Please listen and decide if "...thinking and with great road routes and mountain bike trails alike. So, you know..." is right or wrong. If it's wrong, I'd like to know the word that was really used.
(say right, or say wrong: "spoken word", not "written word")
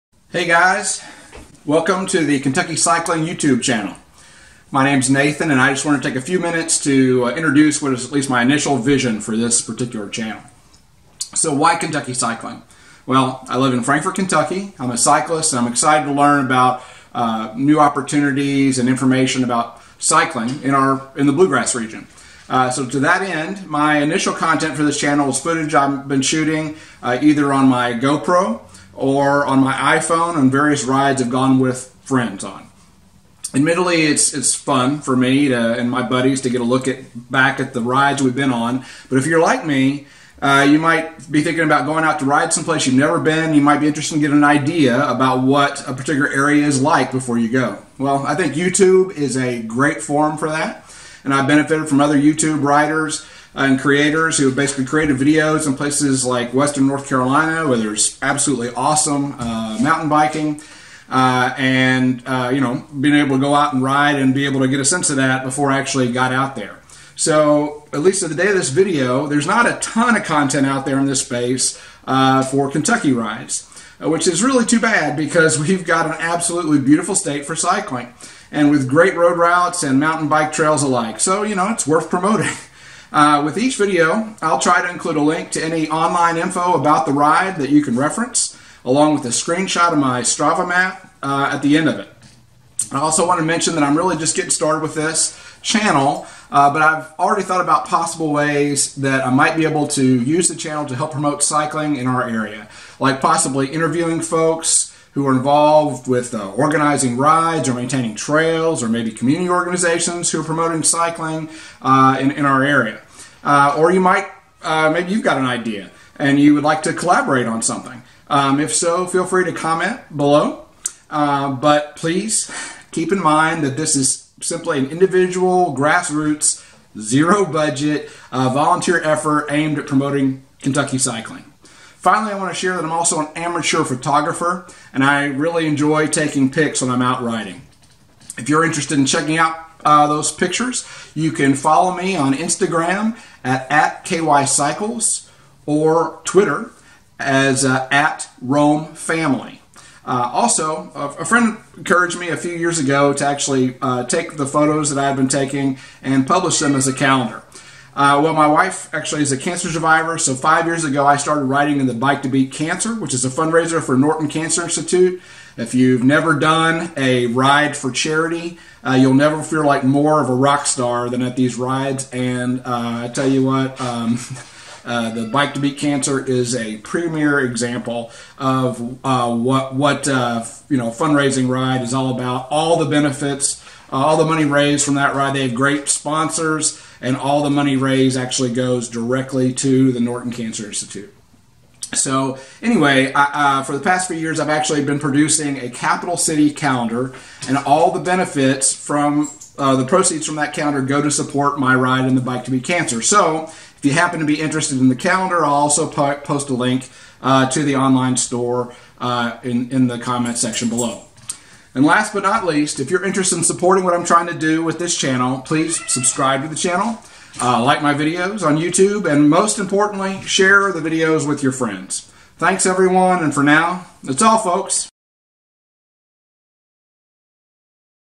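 wrong: "cycling", not "thinking".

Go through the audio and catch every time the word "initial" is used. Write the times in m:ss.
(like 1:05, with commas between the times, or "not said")
0:08, 0:23.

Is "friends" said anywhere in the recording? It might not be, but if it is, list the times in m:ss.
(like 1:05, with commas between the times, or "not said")
0:32, 2:31, 3:41.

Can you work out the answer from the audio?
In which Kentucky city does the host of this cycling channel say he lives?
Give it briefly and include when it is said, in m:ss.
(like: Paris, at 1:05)
Frankfort, at 0:13.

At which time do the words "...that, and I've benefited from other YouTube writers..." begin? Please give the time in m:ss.
0:50.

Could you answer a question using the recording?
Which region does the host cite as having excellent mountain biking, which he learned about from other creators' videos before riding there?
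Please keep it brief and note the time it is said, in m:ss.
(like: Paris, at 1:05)
Western North Carolina, at 0:56.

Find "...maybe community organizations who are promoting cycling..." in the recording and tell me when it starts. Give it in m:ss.
1:48.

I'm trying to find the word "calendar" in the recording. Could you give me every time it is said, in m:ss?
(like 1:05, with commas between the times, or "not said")
2:36, 3:16, 3:20, 3:24.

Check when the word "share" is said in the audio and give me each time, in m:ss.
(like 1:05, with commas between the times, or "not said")
2:12, 3:40.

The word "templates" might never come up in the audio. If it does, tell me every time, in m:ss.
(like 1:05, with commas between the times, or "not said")
not said.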